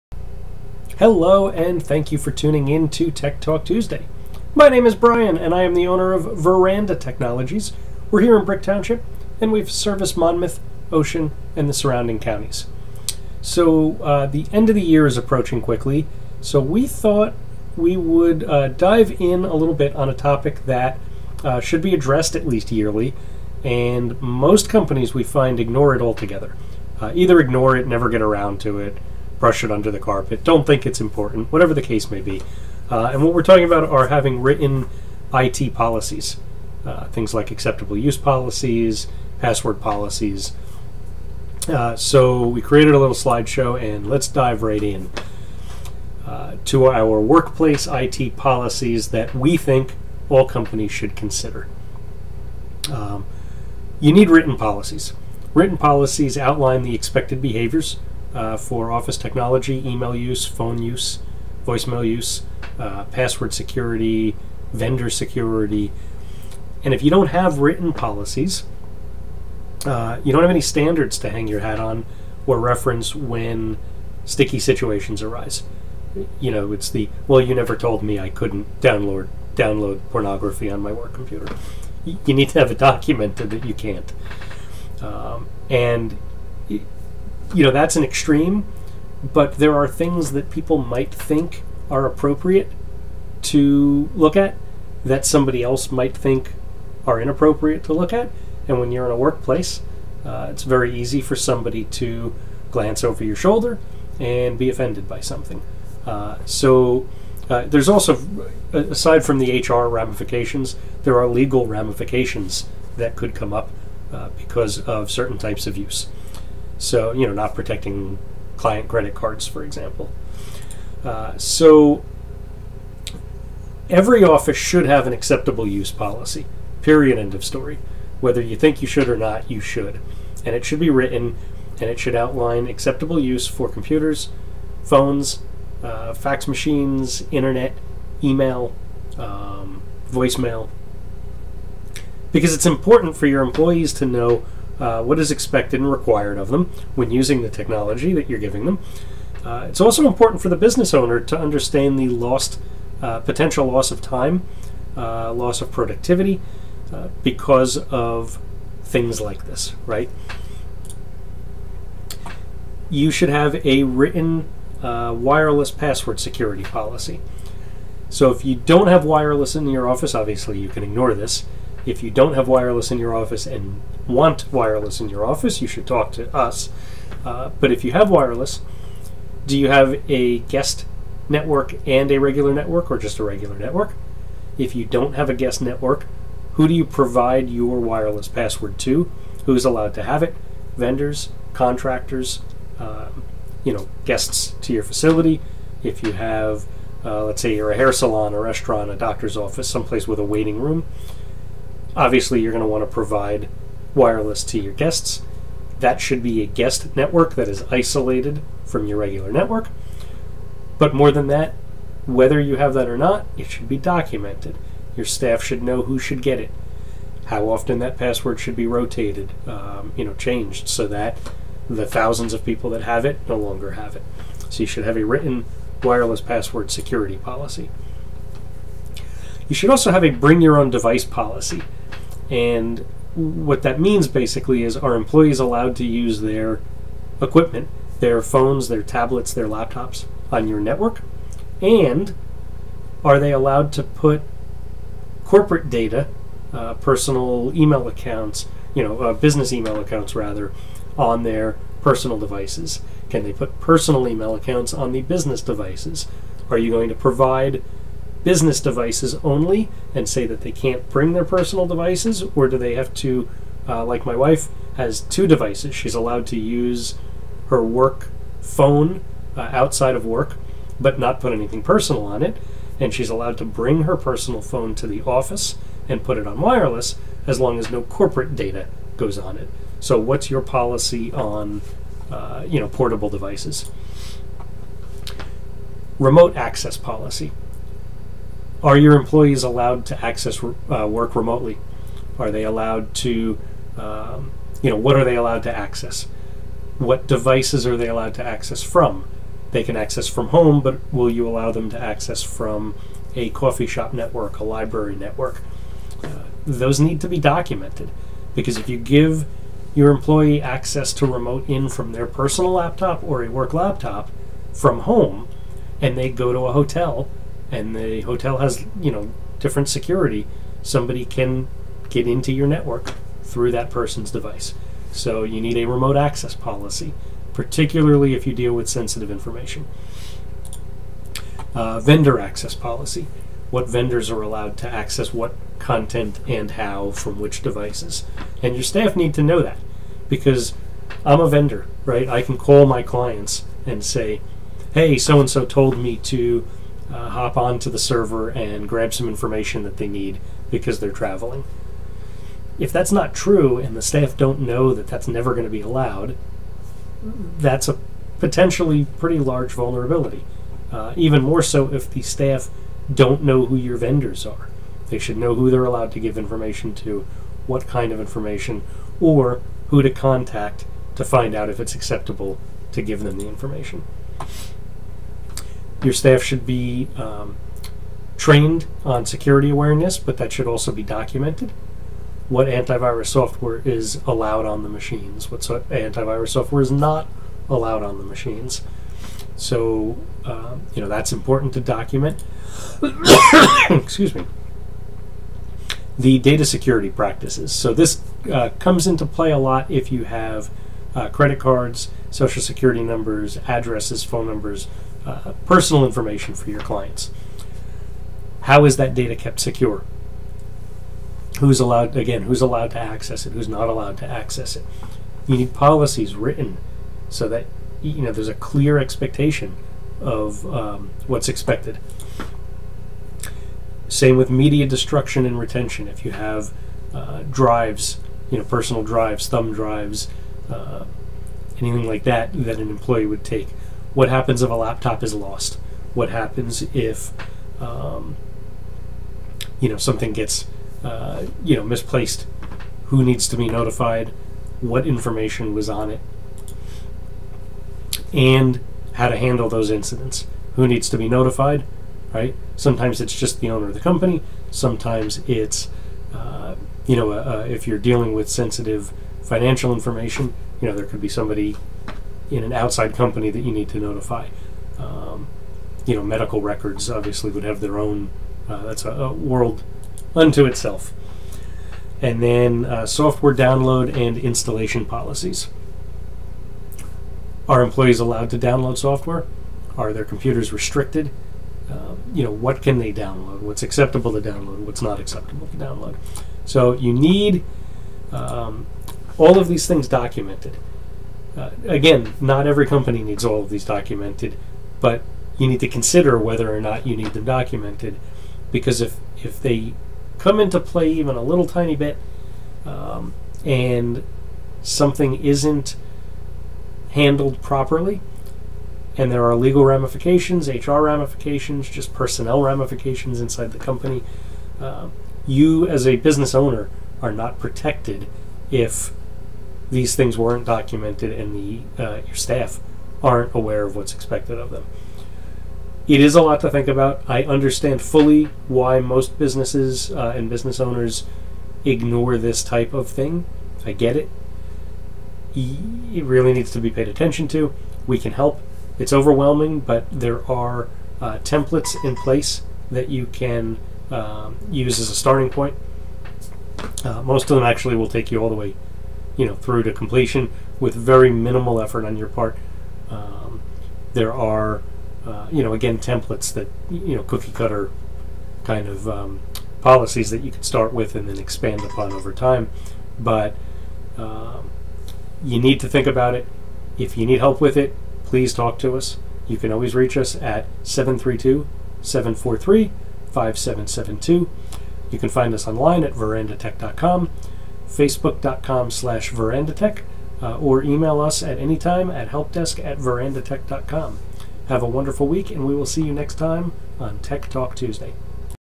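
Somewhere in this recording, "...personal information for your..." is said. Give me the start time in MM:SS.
06:45.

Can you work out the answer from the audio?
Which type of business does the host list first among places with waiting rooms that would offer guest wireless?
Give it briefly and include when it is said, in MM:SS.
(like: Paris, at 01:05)
hair salon, at 03:17.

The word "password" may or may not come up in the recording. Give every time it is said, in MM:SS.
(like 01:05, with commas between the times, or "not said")
00:39, 01:03, 02:45, 03:08, 03:37, 03:46.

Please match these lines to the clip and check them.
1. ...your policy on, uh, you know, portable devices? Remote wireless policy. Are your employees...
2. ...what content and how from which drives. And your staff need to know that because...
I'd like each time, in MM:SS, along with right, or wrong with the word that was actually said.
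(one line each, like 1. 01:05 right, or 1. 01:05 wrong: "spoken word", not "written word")
1. 04:40 wrong: "access", not "wireless"
2. 05:35 wrong: "devices", not "drives".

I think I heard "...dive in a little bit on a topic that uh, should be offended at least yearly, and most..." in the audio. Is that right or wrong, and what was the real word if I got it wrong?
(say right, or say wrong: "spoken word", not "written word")
wrong: "addressed", not "offended".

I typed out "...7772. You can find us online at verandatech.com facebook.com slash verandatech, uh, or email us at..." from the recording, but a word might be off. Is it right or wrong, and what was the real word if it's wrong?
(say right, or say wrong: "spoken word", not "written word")
wrong: "5772", not "7772".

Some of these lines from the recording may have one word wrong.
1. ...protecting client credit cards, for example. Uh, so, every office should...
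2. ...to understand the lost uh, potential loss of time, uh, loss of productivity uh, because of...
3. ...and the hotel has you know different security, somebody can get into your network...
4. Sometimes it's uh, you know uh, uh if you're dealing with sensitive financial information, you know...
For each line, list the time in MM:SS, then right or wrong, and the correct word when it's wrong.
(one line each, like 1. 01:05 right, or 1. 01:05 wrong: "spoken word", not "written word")
1. 01:57 right
2. 02:31 right
3. 05:17 right
4. 07:34 right.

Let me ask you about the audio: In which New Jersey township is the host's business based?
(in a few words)
Brick Township.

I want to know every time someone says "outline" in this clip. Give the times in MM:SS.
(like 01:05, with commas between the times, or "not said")
00:56, 02:12.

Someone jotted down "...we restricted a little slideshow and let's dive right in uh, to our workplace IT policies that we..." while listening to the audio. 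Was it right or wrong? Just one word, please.
wrong.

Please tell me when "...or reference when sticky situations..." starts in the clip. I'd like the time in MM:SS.
01:12.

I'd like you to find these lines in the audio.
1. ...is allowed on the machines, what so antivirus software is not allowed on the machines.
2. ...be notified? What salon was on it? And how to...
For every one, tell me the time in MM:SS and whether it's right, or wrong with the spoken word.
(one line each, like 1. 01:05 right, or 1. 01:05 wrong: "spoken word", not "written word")
1. 06:23 right
2. 07:23 wrong: "information", not "salon".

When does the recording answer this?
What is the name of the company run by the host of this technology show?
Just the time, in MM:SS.
00:06.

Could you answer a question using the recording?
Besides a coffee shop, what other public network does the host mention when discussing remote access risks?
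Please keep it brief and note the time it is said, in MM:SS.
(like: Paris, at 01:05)
library network, at 05:04.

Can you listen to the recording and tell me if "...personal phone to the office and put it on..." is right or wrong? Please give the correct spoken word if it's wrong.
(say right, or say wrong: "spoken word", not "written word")
right.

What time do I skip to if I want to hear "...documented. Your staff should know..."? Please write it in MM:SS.
03:33.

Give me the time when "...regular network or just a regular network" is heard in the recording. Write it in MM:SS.
03:02.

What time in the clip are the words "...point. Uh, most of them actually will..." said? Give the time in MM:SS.
09:05.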